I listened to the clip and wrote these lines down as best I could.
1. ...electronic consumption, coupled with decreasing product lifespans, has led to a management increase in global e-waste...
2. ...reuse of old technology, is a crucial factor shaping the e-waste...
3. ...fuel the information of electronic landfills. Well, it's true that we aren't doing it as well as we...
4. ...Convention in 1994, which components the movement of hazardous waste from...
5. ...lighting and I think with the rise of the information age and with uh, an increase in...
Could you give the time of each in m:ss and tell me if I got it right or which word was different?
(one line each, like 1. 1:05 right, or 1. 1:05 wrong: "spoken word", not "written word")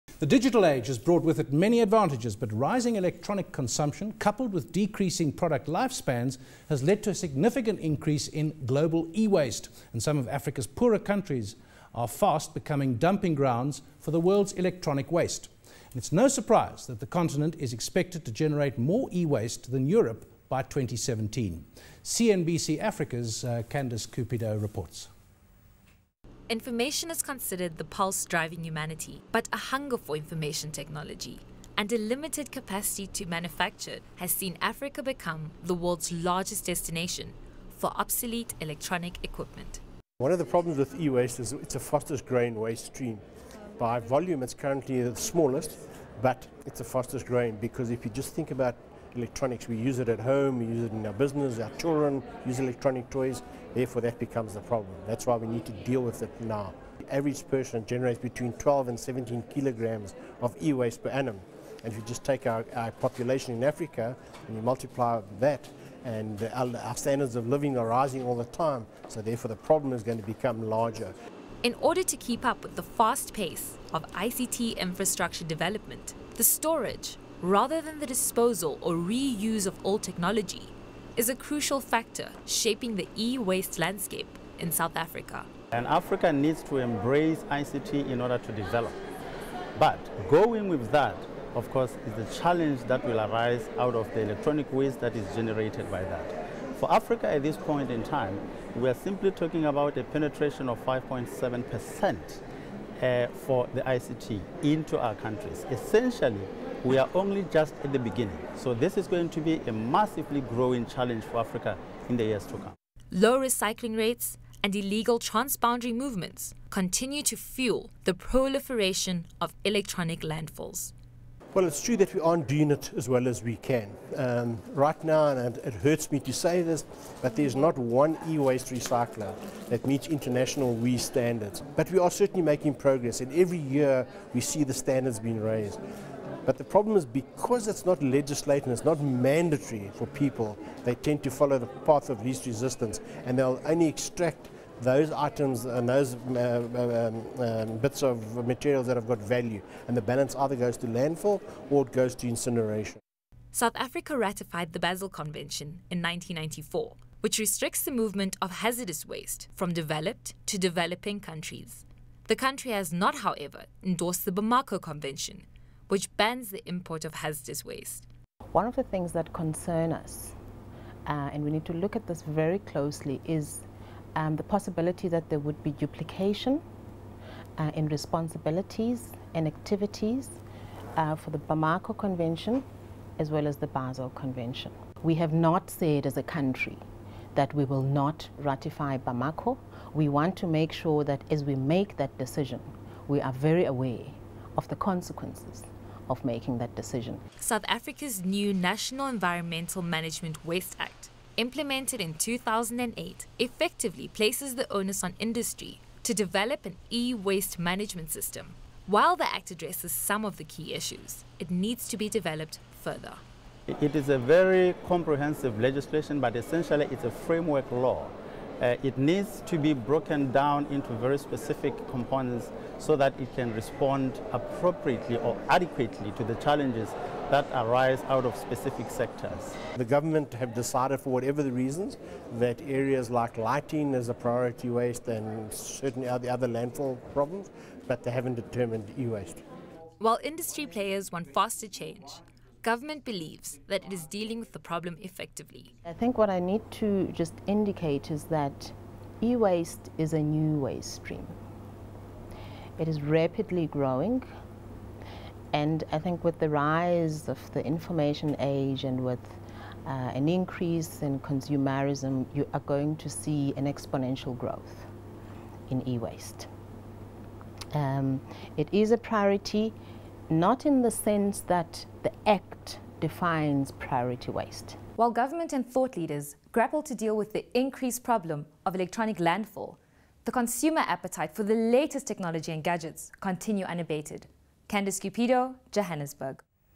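1. 0:02 wrong: "significant", not "management"
2. 1:18 right
3. 1:57 wrong: "proliferation", not "information"
4. 2:35 wrong: "restricts", not "components"
5. 4:13 wrong: "growing", not "lighting".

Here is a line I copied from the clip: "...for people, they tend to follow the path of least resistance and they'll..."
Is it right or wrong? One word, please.
right.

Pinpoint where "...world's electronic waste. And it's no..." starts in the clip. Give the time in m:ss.
0:14.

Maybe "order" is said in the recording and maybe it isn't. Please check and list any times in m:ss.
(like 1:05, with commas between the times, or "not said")
1:11, 1:28.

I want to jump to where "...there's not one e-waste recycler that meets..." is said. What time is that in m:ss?
2:07.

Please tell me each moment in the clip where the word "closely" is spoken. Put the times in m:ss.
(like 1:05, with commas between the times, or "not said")
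2:52.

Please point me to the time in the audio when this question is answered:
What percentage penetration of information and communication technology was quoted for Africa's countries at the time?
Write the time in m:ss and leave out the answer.
1:40.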